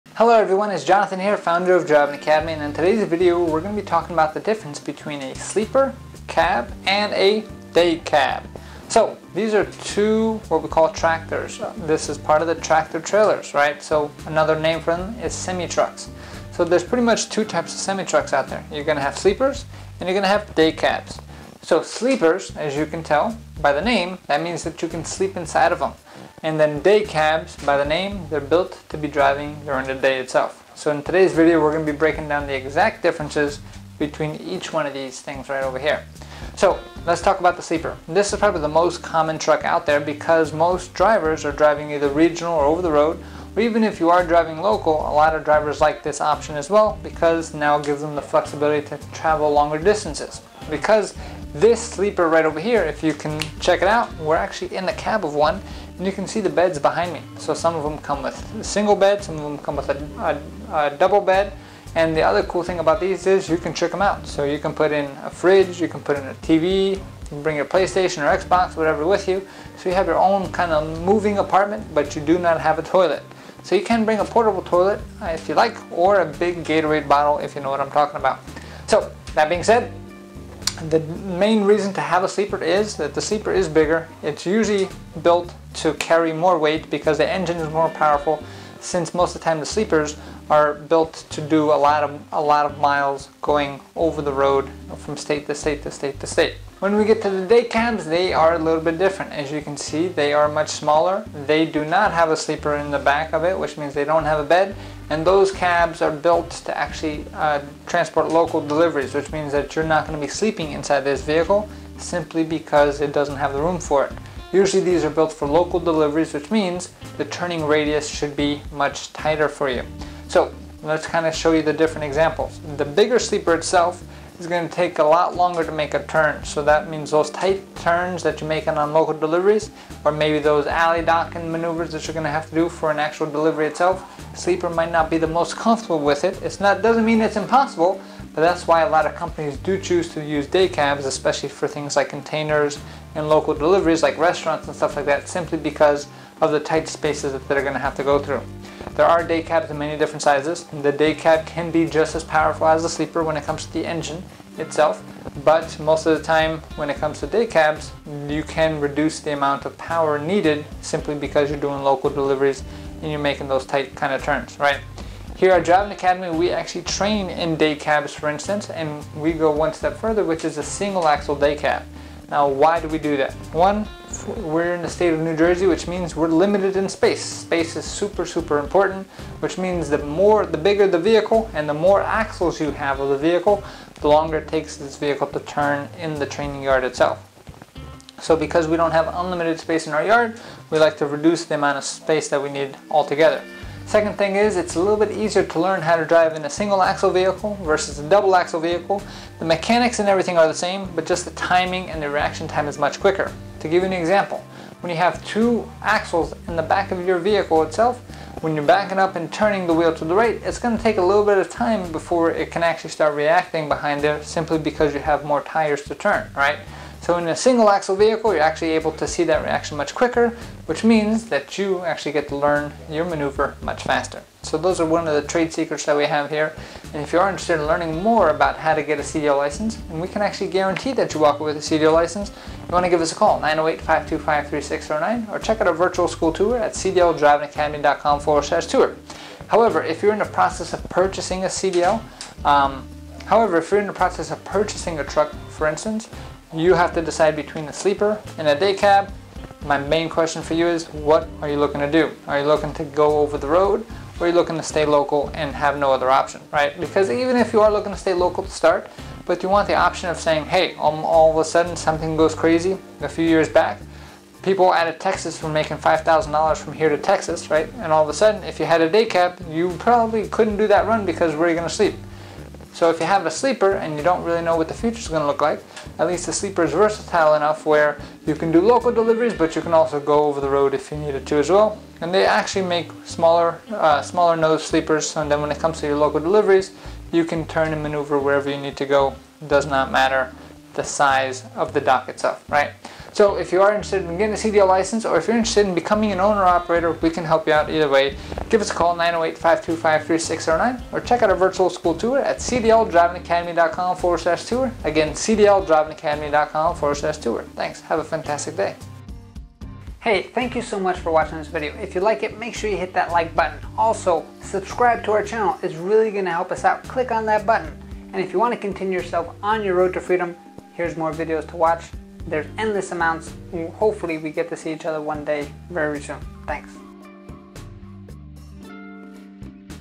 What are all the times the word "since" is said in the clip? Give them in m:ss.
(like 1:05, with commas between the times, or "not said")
1:28.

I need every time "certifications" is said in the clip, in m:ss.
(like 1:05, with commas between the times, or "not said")
not said.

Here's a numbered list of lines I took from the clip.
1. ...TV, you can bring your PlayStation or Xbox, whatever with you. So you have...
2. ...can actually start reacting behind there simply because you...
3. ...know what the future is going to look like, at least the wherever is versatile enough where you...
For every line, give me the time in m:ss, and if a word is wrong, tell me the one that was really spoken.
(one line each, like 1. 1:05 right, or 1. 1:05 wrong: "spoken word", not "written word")
1. 1:06 right
2. 3:32 right
3. 4:34 wrong: "sleeper", not "wherever".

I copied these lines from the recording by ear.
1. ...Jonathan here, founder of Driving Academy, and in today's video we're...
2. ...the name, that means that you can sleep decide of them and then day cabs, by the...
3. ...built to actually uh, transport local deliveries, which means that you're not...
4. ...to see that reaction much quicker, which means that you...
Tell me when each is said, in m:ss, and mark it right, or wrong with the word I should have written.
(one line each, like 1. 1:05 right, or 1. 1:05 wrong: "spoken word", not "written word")
1. 0:00 right
2. 0:23 wrong: "inside", not "decide"
3. 1:46 right
4. 3:38 right.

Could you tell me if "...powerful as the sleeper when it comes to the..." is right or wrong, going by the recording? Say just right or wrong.
right.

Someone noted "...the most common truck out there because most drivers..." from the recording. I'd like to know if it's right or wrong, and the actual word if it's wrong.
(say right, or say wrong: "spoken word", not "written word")
right.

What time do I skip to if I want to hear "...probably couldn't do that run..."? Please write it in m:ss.
4:29.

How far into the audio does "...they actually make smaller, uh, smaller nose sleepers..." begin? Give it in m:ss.
4:42.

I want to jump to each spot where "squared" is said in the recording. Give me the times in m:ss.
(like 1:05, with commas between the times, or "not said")
not said.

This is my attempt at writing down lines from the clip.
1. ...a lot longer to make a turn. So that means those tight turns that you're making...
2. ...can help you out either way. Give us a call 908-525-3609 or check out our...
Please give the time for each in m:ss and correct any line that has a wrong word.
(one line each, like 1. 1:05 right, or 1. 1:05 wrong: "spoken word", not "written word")
1. 2:04 right
2. 4:57 right.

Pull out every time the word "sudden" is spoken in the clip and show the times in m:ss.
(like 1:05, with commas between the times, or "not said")
4:21, 4:28.